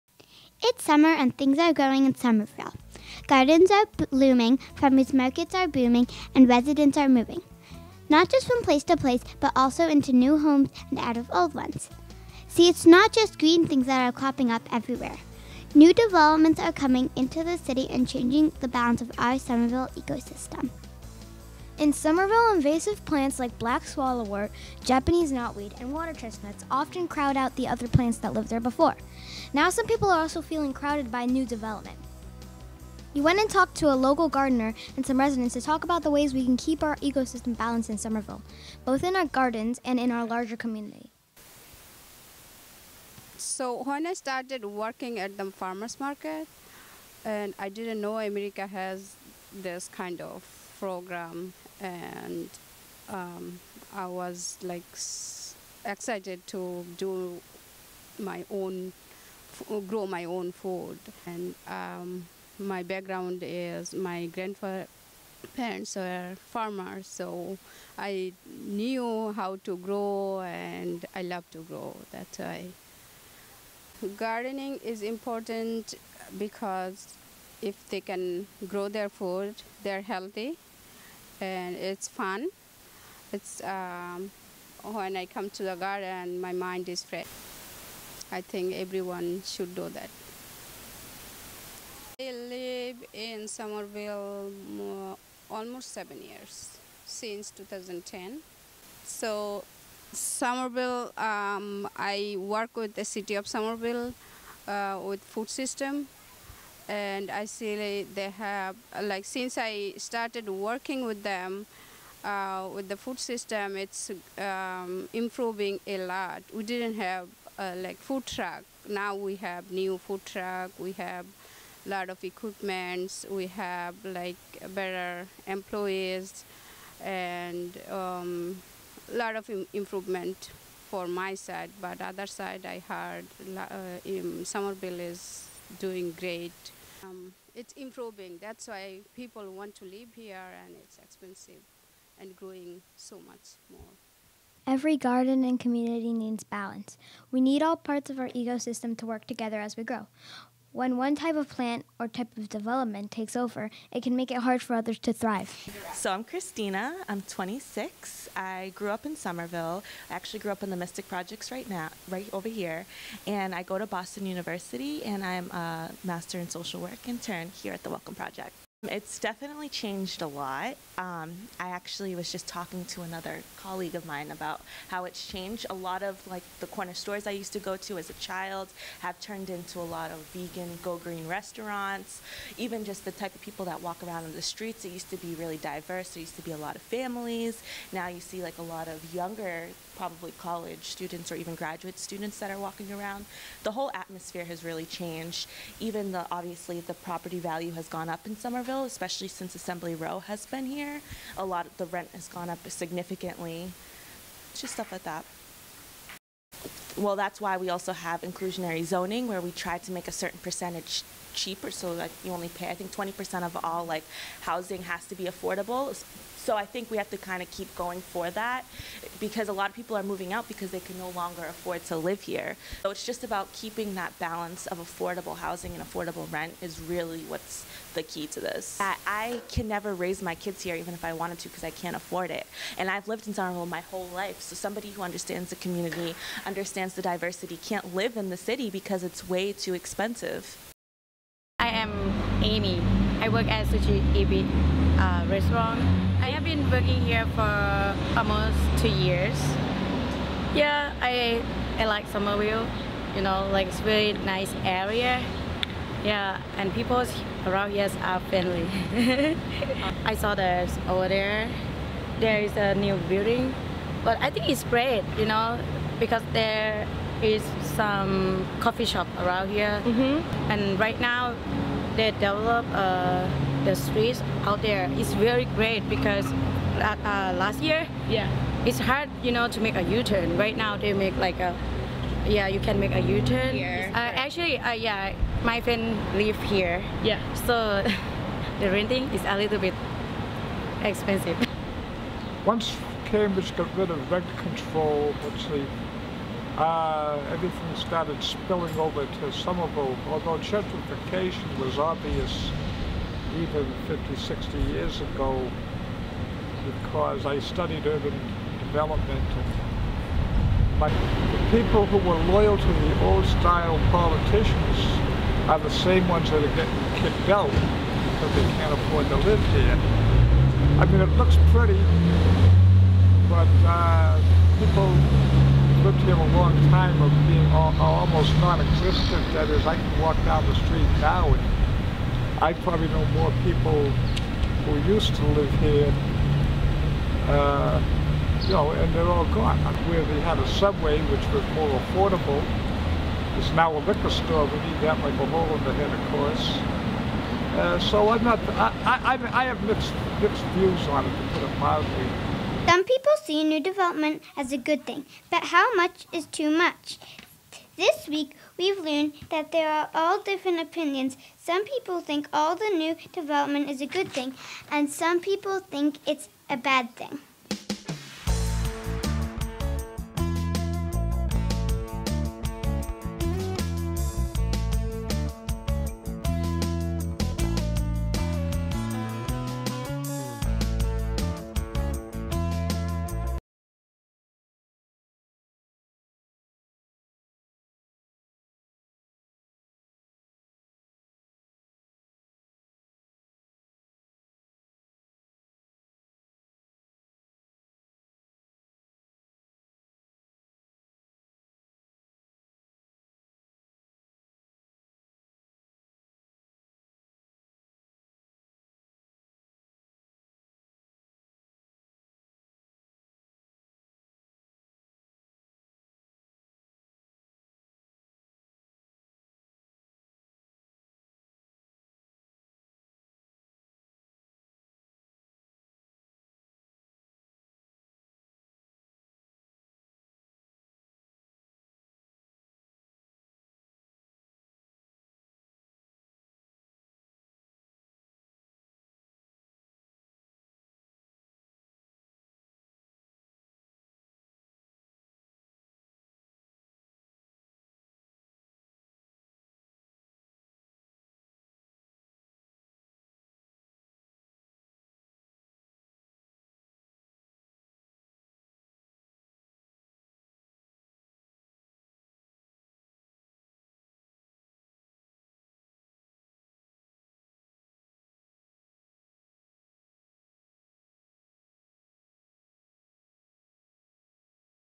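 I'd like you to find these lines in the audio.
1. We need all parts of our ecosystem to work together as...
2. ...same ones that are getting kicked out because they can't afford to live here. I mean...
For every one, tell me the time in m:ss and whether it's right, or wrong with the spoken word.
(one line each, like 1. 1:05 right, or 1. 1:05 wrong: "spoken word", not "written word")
1. 2:27 right
2. 5:15 right.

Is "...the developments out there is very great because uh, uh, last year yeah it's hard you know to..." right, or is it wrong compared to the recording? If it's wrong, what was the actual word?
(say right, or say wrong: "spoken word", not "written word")
wrong: "streets", not "developments".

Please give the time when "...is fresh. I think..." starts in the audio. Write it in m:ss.
1:26.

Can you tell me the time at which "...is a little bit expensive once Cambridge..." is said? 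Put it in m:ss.
4:49.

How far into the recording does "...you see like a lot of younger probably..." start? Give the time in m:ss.
3:08.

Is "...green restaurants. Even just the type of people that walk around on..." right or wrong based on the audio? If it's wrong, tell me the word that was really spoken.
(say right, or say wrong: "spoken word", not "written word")
right.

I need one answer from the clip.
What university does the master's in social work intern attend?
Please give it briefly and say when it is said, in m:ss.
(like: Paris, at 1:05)
Boston University, at 2:43.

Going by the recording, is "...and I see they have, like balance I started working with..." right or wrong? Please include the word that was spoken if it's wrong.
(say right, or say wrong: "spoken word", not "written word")
wrong: "since", not "balance".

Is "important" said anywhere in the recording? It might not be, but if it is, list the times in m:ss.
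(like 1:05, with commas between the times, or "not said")
1:15.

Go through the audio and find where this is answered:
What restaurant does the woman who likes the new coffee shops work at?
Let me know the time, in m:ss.
4:03.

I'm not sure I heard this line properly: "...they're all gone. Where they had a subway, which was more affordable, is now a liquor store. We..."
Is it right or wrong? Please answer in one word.
right.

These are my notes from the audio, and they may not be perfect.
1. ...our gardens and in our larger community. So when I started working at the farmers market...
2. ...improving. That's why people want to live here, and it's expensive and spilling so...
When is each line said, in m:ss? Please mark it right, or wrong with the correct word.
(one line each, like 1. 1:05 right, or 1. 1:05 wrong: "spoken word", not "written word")
1. 0:39 right
2. 2:17 wrong: "growing", not "spilling".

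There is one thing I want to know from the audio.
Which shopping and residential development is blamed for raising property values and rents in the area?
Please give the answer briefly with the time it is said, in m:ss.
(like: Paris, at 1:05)
Assembly Row, at 3:19.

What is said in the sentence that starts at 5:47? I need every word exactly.
Uh, so I'm not, I, I, I have mixed, mixed views on it, to put it mildly.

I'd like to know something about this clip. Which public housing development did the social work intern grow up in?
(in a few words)
Mystic Projects.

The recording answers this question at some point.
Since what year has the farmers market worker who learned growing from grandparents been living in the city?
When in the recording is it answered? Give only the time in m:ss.
1:37.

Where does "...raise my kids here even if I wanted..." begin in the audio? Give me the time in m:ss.
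3:49.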